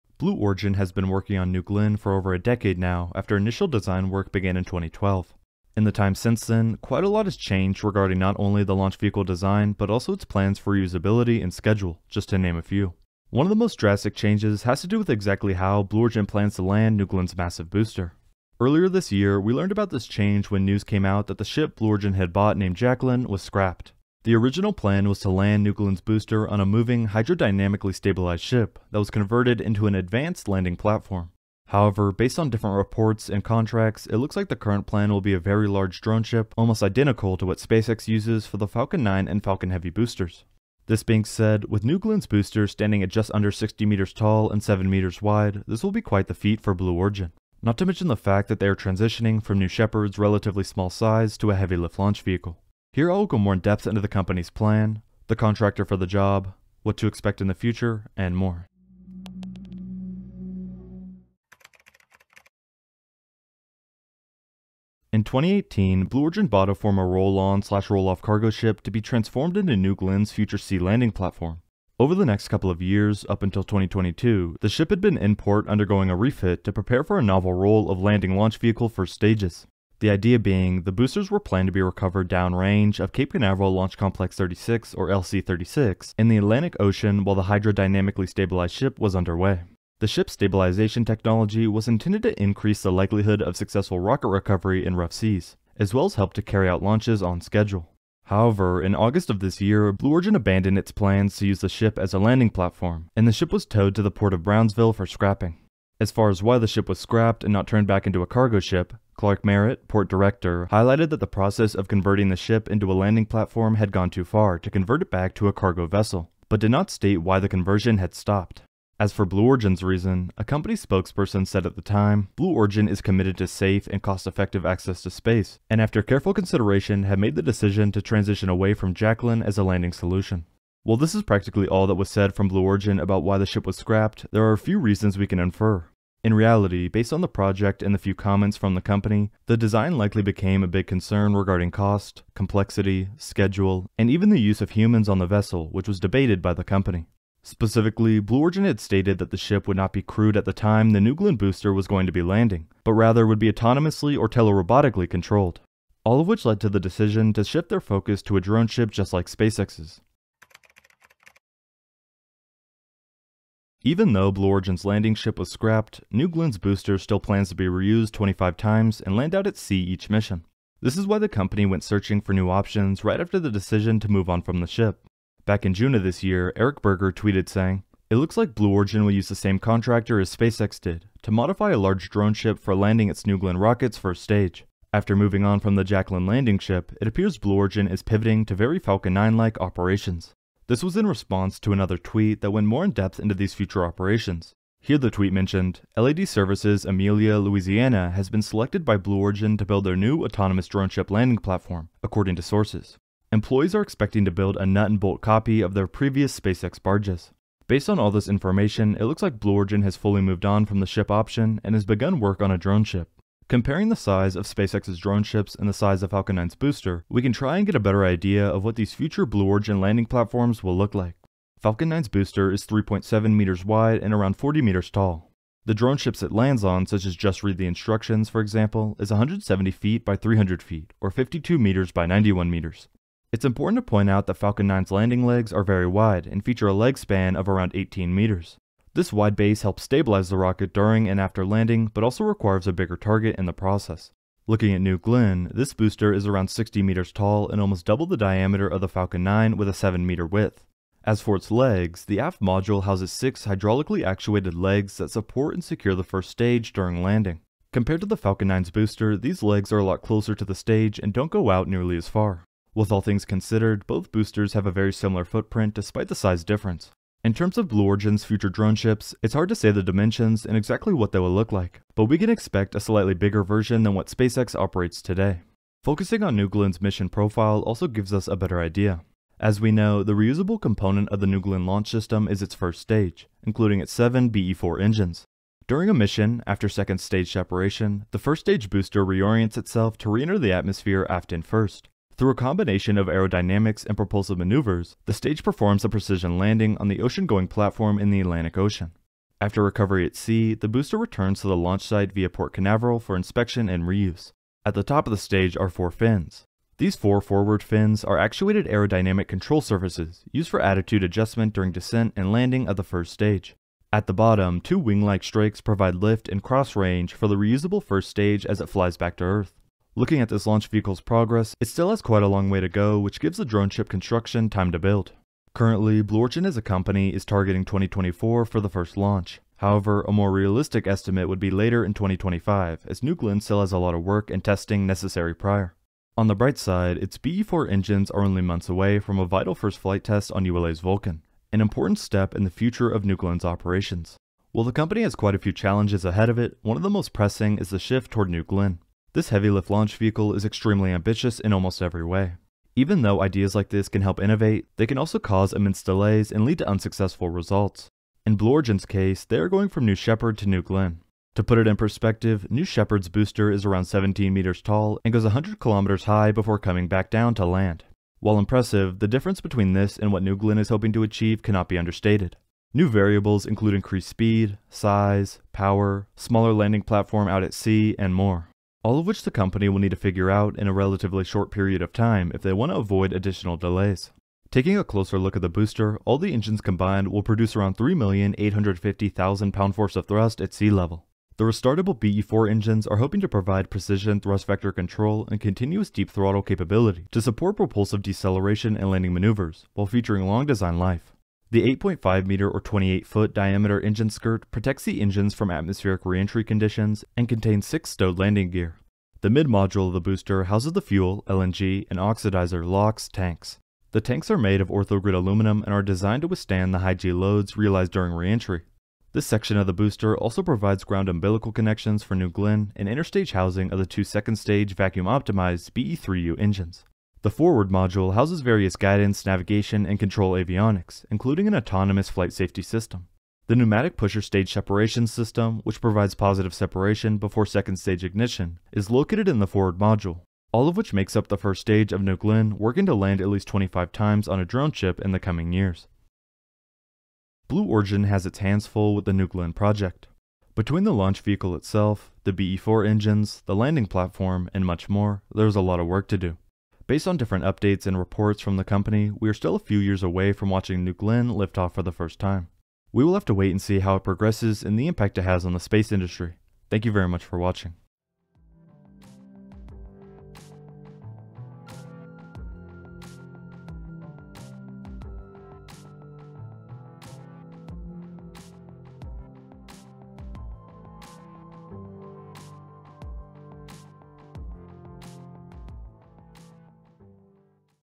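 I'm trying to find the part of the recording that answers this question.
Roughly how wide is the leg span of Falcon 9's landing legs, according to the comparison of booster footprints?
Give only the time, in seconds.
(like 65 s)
237 s.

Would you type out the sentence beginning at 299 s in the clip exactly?
After recovery at sea, the booster returns to the launch site via Port Canaveral for inspection and reuse.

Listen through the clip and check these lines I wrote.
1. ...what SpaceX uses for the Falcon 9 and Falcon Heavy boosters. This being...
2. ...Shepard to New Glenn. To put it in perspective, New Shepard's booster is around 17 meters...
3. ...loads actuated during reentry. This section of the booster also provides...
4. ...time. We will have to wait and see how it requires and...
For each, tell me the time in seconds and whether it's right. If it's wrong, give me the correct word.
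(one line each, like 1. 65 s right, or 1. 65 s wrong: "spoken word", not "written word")
1. 37 s right
2. 359 s right
3. 417 s wrong: "realized", not "actuated"
4. 462 s wrong: "progresses", not "requires".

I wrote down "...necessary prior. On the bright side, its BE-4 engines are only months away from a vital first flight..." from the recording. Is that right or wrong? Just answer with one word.
right.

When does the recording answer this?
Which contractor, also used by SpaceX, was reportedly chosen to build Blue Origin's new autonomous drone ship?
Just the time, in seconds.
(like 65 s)
195 s.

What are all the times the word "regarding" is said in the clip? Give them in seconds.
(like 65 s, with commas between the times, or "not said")
7 s, 141 s.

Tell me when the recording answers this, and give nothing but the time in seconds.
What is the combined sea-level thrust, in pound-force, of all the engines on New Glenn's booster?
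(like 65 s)
387 s.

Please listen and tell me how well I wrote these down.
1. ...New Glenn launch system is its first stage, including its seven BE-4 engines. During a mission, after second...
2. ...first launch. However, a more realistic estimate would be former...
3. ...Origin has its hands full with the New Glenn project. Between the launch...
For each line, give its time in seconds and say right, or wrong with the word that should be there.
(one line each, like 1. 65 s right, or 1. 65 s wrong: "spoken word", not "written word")
1. 281 s right
2. 328 s wrong: "later", not "former"
3. 447 s right.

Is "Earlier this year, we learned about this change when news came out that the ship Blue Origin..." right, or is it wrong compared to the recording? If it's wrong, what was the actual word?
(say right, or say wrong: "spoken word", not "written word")
right.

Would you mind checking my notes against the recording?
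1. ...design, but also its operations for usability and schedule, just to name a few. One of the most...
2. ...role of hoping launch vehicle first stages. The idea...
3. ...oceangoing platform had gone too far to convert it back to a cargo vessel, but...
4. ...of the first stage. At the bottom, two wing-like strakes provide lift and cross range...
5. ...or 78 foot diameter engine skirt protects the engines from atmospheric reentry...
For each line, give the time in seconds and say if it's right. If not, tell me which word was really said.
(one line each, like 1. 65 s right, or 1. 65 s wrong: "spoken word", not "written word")
1. 9 s wrong: "plans", not "operations"
2. 77 s wrong: "landing", not "hoping"
3. 112 s wrong: "landing", not "oceangoing"
4. 312 s right
5. 402 s wrong: "28", not "78".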